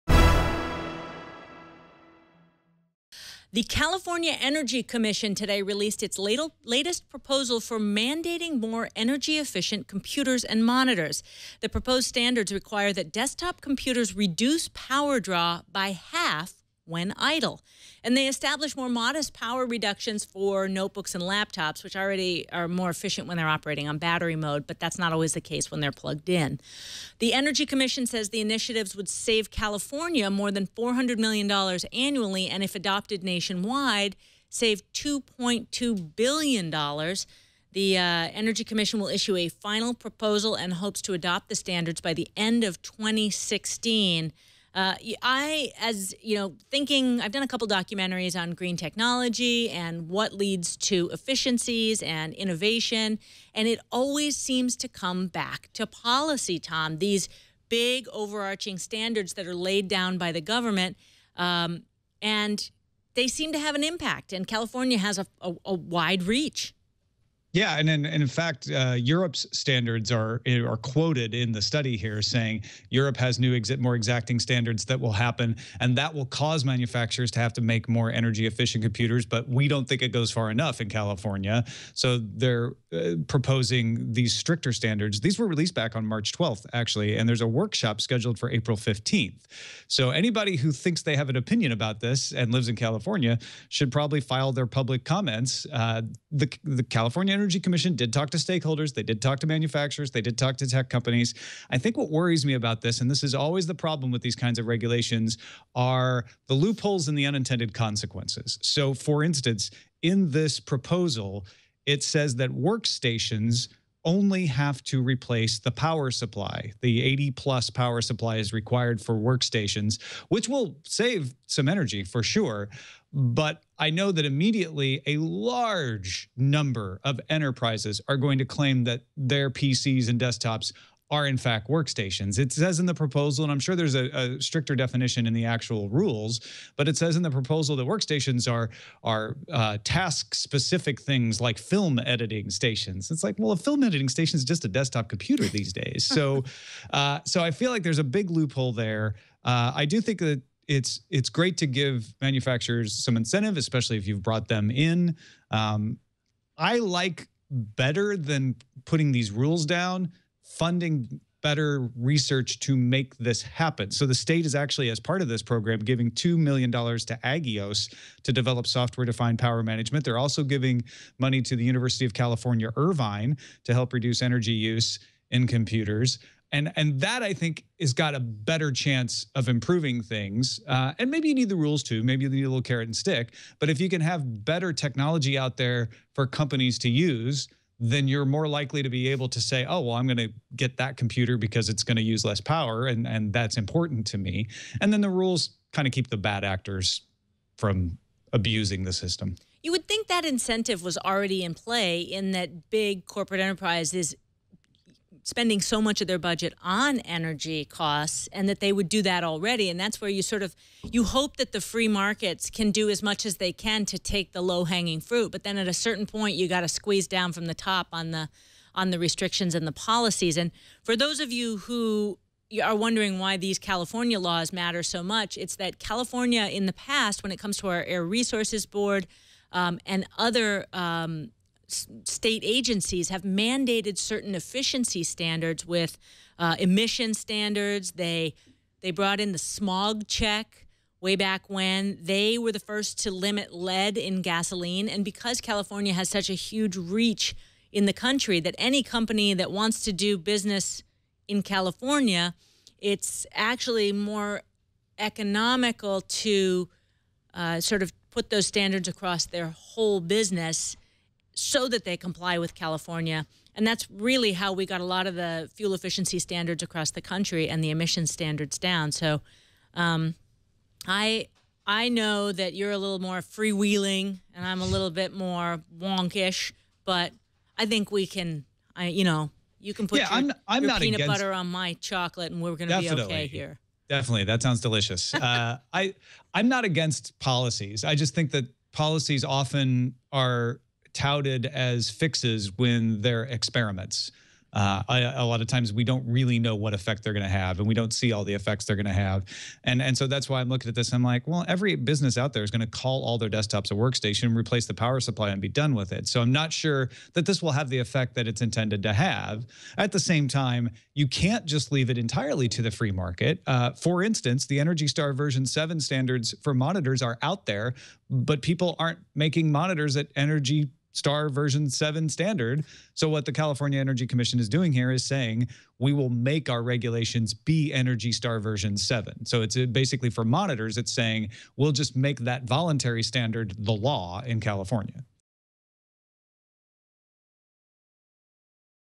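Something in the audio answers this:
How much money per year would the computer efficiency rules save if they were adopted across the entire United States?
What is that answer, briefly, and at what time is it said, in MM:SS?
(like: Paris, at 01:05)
$2.2 billion, at 00:34.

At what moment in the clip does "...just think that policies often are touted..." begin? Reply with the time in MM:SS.
04:47.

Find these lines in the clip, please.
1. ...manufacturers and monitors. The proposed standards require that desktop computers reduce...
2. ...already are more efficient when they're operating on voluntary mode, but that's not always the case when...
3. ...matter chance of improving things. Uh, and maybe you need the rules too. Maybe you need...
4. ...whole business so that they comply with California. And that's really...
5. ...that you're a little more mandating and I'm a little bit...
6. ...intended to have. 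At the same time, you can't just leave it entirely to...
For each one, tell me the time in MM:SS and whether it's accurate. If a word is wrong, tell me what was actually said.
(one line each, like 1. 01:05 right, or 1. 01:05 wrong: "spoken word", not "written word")
1. 00:09 wrong: "computers", not "manufacturers"
2. 00:21 wrong: "battery", not "voluntary"
3. 02:58 wrong: "better", not "matter"
4. 04:19 right
5. 04:32 wrong: "freewheeling", not "mandating"
6. 05:08 right.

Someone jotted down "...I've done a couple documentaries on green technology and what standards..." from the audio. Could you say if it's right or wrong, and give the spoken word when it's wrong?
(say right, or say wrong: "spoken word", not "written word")
wrong: "leads", not "standards".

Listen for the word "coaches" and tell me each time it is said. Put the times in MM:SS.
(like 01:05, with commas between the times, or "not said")
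not said.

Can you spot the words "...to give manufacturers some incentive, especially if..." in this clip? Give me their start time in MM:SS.
02:31.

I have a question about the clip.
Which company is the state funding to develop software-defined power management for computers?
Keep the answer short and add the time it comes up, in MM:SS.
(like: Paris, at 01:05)
Aggios, at 02:47.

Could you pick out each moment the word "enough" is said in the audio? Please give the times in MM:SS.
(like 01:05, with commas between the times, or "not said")
01:20.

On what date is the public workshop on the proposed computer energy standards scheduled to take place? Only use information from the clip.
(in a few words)
April 15th.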